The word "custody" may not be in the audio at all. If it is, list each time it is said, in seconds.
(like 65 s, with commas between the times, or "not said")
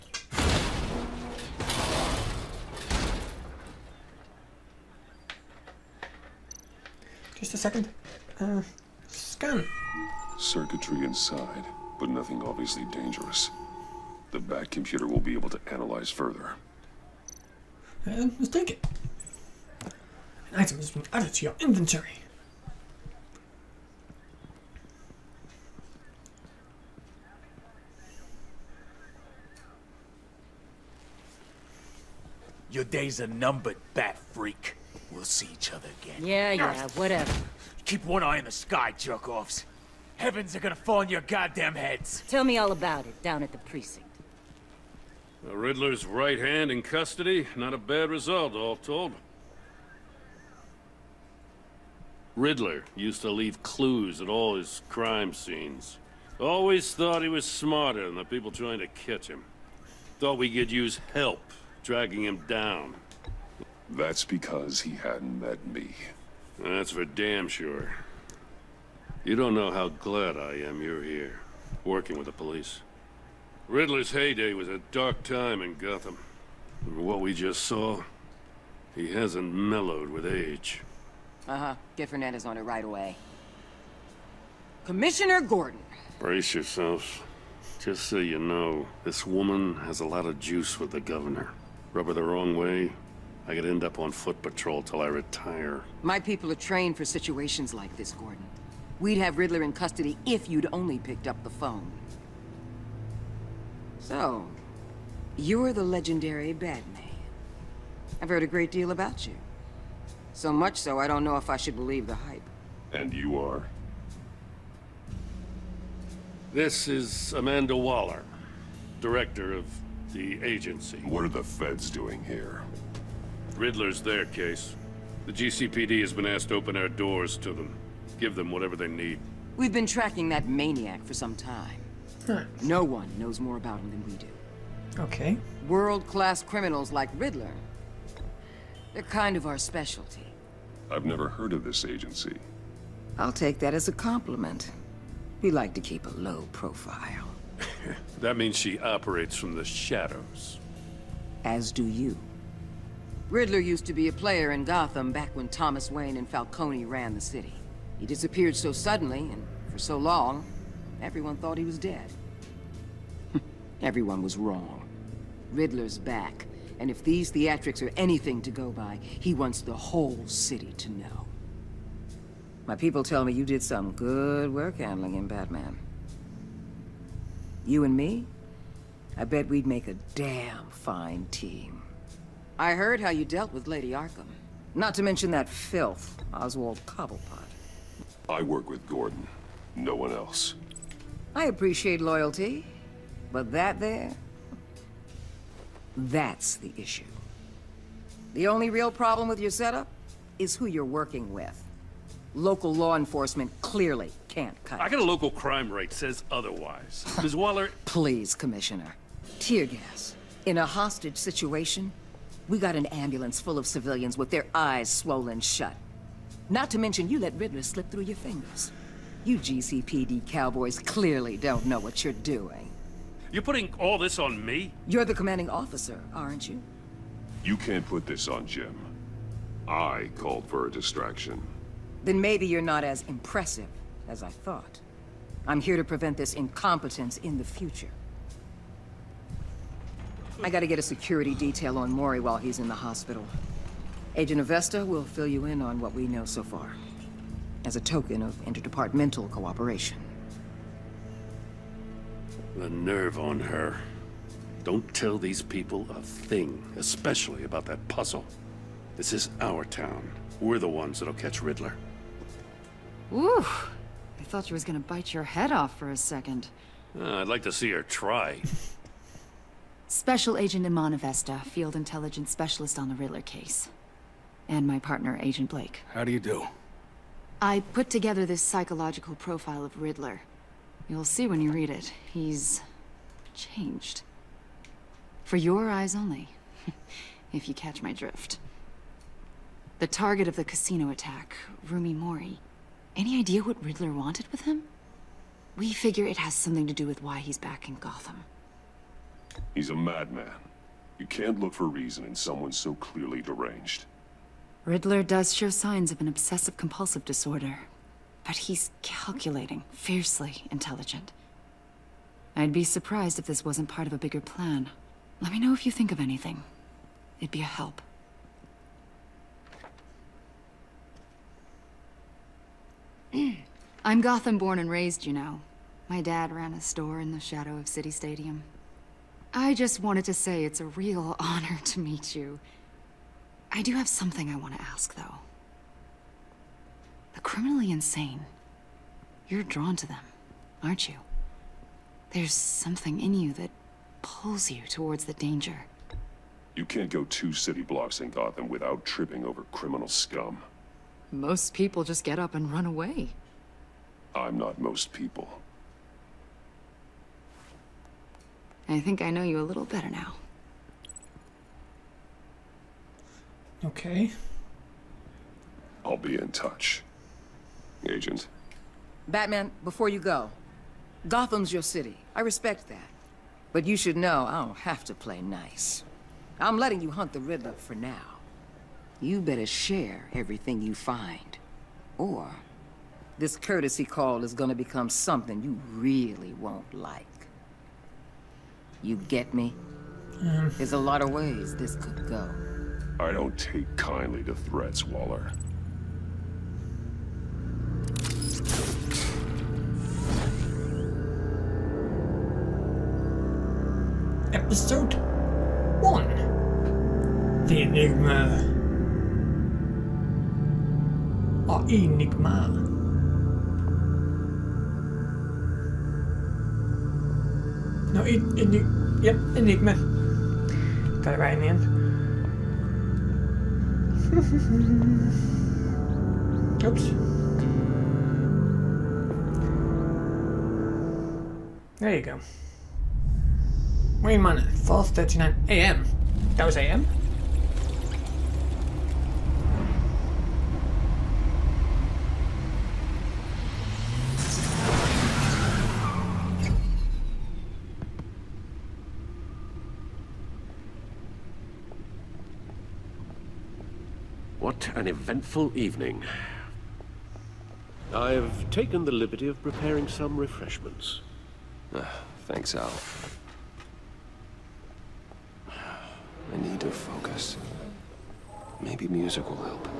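46 s, 99 s.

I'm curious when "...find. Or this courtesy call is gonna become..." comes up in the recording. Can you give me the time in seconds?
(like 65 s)
380 s.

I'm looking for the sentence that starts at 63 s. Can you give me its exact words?
That's because he hadn't met me.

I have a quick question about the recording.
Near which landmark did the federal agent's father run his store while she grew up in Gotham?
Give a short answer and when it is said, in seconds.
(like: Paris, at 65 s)
City Stadium, at 327 s.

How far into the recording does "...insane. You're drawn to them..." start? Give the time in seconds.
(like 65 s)
337 s.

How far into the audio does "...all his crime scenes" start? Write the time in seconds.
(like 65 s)
54 s.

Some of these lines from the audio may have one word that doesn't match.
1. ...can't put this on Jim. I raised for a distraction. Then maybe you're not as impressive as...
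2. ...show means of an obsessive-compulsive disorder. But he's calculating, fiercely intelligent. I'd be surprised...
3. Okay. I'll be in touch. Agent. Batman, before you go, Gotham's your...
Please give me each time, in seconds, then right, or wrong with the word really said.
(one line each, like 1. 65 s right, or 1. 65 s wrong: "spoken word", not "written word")
1. 227 s wrong: "called", not "raised"
2. 305 s wrong: "signs", not "means"
3. 363 s right.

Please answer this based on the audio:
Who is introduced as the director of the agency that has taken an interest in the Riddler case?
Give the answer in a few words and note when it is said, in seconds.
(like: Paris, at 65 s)
Amanda Waller, at 117 s.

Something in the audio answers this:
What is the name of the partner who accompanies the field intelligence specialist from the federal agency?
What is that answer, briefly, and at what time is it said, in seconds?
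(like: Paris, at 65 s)
Agent Blake, at 275 s.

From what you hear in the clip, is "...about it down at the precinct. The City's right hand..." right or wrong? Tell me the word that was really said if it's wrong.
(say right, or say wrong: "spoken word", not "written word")
wrong: "Riddler", not "City".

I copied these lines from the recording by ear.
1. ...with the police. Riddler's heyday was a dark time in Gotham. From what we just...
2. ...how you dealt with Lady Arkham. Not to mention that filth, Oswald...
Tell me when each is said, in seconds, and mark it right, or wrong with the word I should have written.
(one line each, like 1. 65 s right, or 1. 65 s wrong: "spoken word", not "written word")
1. 72 s right
2. 182 s right.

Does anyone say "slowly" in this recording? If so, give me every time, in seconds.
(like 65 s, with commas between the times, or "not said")
not said.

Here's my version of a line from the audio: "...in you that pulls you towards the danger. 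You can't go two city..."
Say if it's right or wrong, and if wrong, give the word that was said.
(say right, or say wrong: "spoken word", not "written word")
right.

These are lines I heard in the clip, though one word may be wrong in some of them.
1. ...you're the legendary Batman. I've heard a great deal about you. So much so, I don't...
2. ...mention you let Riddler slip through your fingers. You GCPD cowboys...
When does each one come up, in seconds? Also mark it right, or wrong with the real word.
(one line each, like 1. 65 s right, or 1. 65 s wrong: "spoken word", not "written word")
1. 105 s right
2. 216 s right.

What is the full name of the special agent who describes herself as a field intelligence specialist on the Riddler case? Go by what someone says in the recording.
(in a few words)
Iman Avesta.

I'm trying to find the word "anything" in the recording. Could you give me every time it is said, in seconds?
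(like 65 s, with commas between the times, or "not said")
167 s, 315 s.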